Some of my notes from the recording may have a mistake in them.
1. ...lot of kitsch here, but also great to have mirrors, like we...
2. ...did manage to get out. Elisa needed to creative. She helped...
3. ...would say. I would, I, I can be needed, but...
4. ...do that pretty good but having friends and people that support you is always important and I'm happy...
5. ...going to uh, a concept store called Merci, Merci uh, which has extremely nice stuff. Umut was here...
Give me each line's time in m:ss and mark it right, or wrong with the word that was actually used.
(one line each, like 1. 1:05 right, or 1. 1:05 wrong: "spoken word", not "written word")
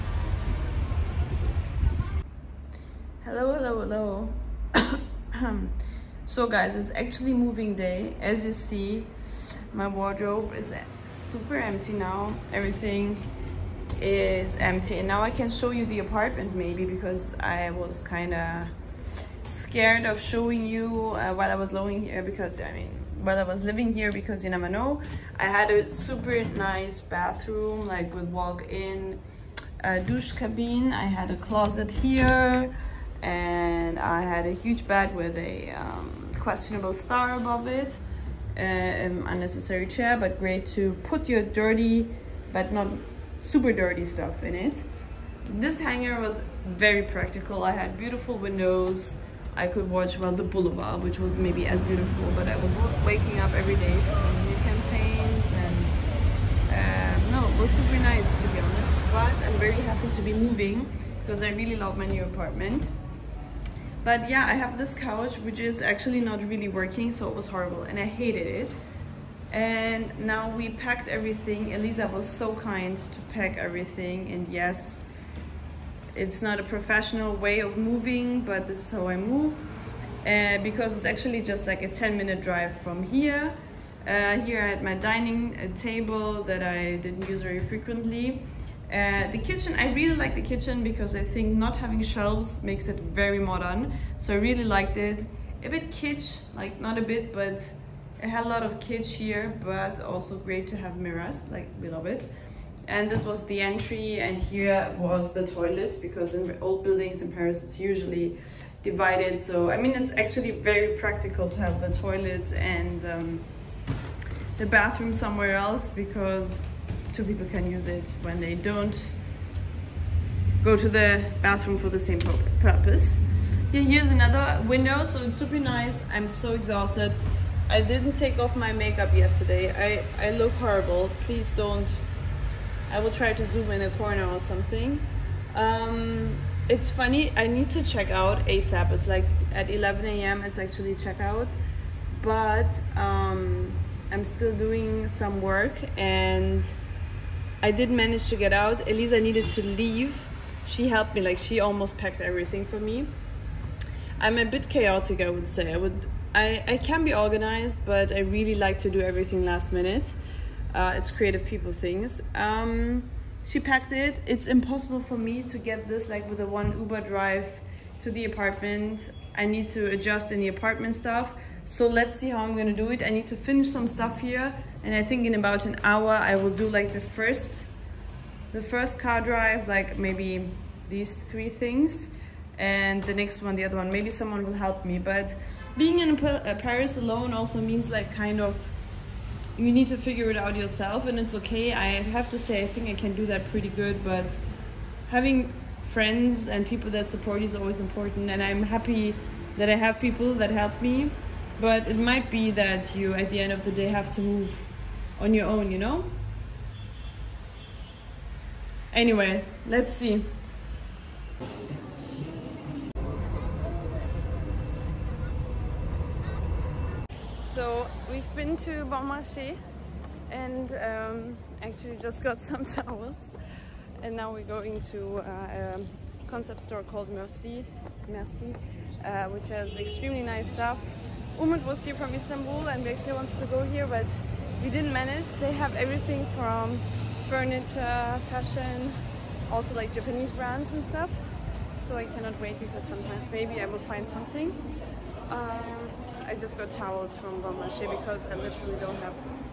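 1. 1:38 right
2. 2:27 wrong: "leave", not "creative"
3. 2:35 wrong: "organized", not "needed"
4. 3:13 right
5. 3:44 right.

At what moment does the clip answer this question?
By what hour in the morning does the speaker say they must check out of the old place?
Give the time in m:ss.
2:19.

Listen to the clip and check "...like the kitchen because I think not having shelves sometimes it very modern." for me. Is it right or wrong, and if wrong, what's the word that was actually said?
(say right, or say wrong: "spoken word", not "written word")
wrong: "makes", not "sometimes".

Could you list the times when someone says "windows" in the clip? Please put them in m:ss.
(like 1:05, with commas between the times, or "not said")
0:48, 2:04.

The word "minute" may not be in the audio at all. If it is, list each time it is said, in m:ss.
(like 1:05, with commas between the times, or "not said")
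1:22, 2:39.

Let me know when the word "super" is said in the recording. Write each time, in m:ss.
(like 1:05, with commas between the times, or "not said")
0:11, 0:25, 0:43, 0:57, 2:05.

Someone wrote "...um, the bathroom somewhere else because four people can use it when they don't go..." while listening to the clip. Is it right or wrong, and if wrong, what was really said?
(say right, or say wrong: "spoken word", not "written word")
wrong: "two", not "four".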